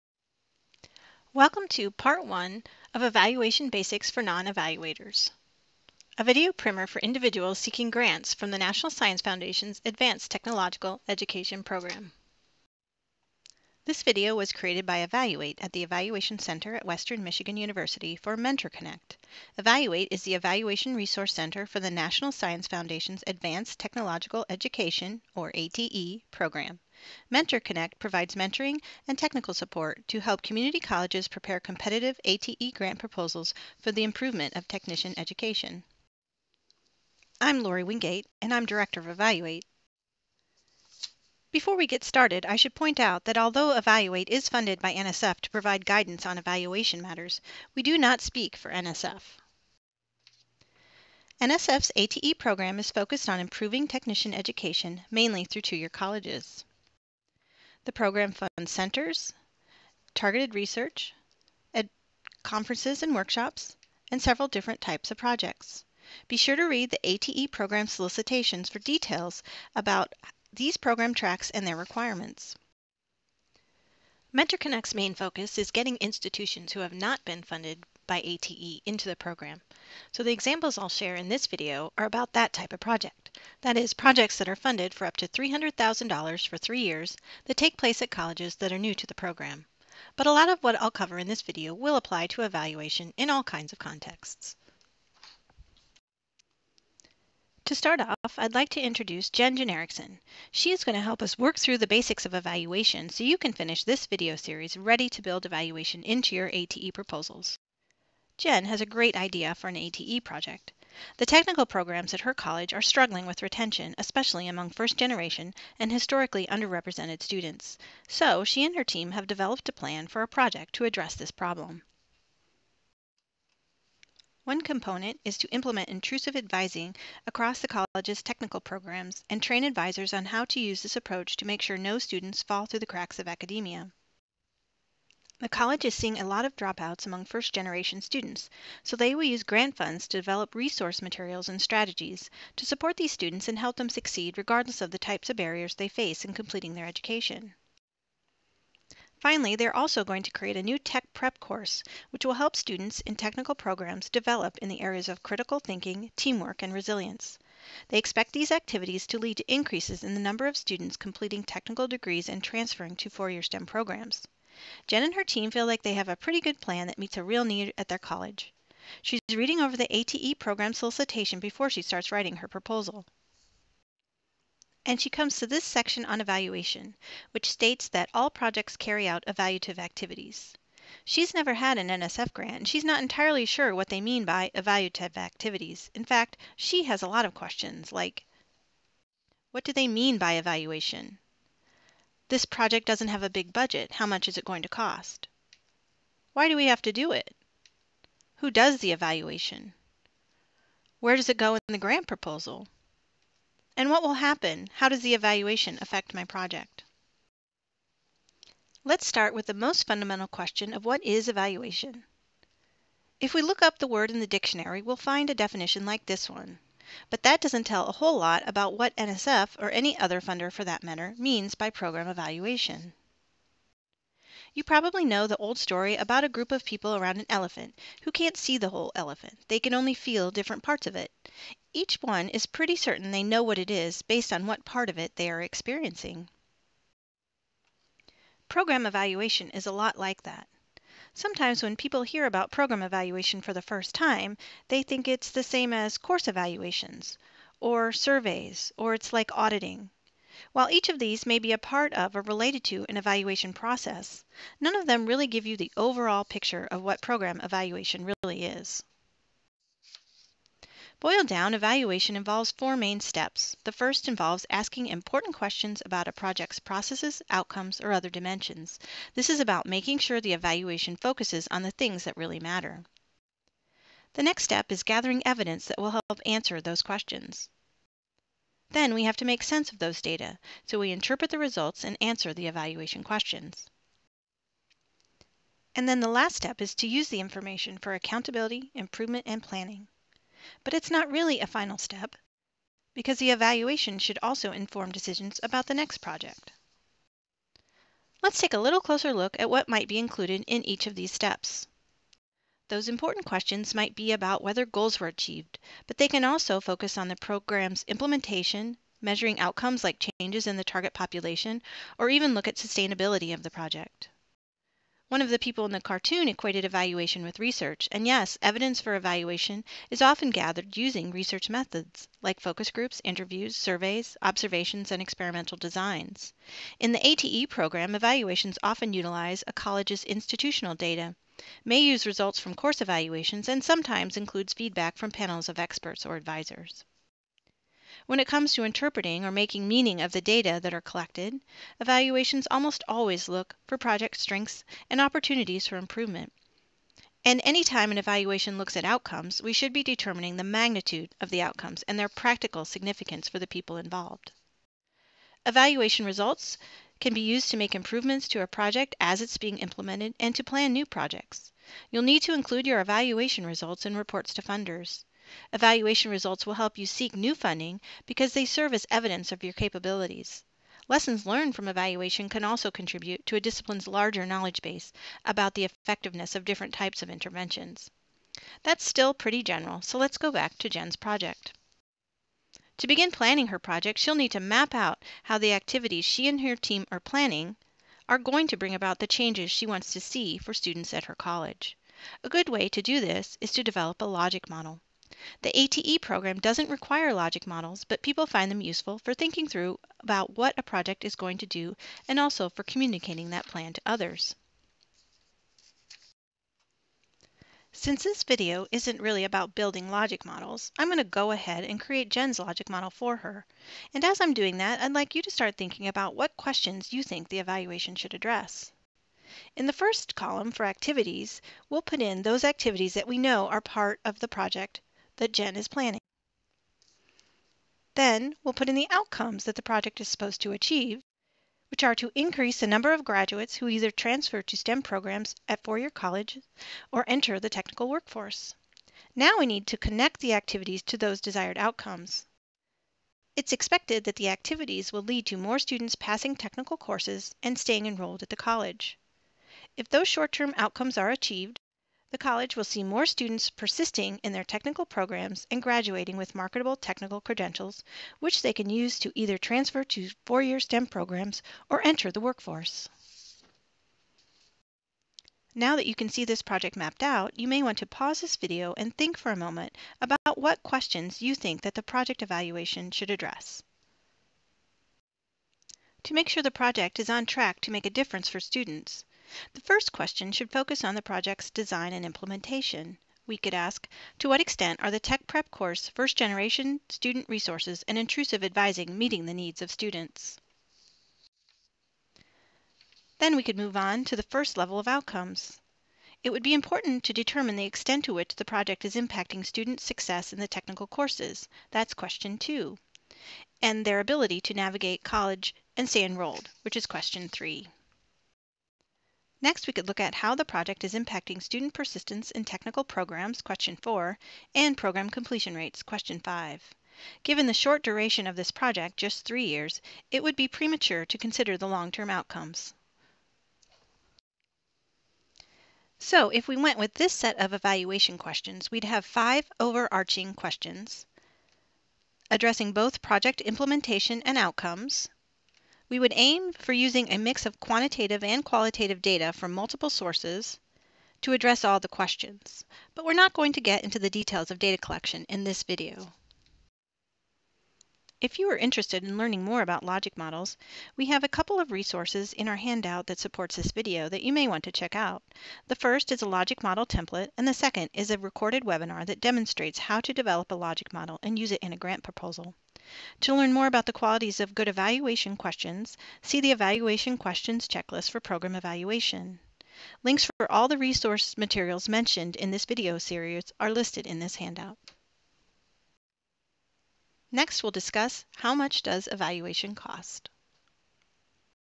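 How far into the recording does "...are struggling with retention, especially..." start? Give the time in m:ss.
1:52.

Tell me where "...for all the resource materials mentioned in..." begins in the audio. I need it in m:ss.
9:30.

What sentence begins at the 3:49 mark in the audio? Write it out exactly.
They can only feel different parts of it.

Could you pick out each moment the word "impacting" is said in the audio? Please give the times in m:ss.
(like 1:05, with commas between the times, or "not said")
8:18, 8:30.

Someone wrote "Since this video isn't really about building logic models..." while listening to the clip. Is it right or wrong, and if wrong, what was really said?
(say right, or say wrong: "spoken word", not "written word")
right.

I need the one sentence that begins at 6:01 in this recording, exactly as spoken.
You'll need to include your evaluation results in reports to funders.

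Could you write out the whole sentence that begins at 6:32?
A good way to do this is to develop a logic model.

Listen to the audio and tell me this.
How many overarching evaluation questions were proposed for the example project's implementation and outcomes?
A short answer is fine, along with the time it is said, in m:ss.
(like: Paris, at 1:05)
5, at 8:49.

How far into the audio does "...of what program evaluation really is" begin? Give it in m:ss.
4:16.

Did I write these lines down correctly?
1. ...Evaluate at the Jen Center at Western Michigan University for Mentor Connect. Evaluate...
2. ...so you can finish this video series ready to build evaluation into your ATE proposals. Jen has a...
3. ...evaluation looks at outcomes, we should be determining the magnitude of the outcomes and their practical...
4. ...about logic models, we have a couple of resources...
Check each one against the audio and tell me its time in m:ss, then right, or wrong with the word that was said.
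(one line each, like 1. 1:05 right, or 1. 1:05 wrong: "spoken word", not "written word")
1. 0:14 wrong: "Evaluation", not "Jen"
2. 1:43 right
3. 5:47 right
4. 9:09 right.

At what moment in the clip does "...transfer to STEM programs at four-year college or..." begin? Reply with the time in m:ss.
7:13.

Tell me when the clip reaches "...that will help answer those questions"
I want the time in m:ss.
4:35.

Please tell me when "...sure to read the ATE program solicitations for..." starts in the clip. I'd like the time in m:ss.
1:06.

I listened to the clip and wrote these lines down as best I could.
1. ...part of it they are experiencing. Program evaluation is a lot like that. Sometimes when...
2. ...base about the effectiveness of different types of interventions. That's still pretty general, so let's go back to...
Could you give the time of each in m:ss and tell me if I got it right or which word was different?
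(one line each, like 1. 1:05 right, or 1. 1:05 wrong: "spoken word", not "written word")
1. 3:54 right
2. 6:14 right.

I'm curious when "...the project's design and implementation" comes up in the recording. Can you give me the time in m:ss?
8:00.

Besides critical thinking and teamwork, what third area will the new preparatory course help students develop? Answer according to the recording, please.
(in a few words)
resilience.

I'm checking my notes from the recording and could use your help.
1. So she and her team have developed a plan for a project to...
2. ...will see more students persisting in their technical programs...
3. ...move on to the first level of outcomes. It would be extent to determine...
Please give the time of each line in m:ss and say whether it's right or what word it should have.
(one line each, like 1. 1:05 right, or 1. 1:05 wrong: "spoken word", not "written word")
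1. 1:58 right
2. 7:32 right
3. 8:13 wrong: "important", not "extent".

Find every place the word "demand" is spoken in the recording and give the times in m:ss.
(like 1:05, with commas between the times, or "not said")
not said.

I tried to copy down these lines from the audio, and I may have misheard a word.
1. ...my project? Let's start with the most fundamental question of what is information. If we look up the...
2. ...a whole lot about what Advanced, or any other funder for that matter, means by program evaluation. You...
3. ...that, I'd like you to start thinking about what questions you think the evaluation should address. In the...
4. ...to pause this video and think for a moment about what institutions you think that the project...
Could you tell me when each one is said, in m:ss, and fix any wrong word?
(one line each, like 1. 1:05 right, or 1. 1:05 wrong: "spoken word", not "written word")
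1. 3:26 wrong: "evaluation", not "information"
2. 3:37 wrong: "NSF", not "Advanced"
3. 6:54 right
4. 7:47 wrong: "questions", not "institutions".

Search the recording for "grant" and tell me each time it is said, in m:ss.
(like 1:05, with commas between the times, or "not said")
0:07, 0:32, 2:19, 3:02, 3:21, 9:21.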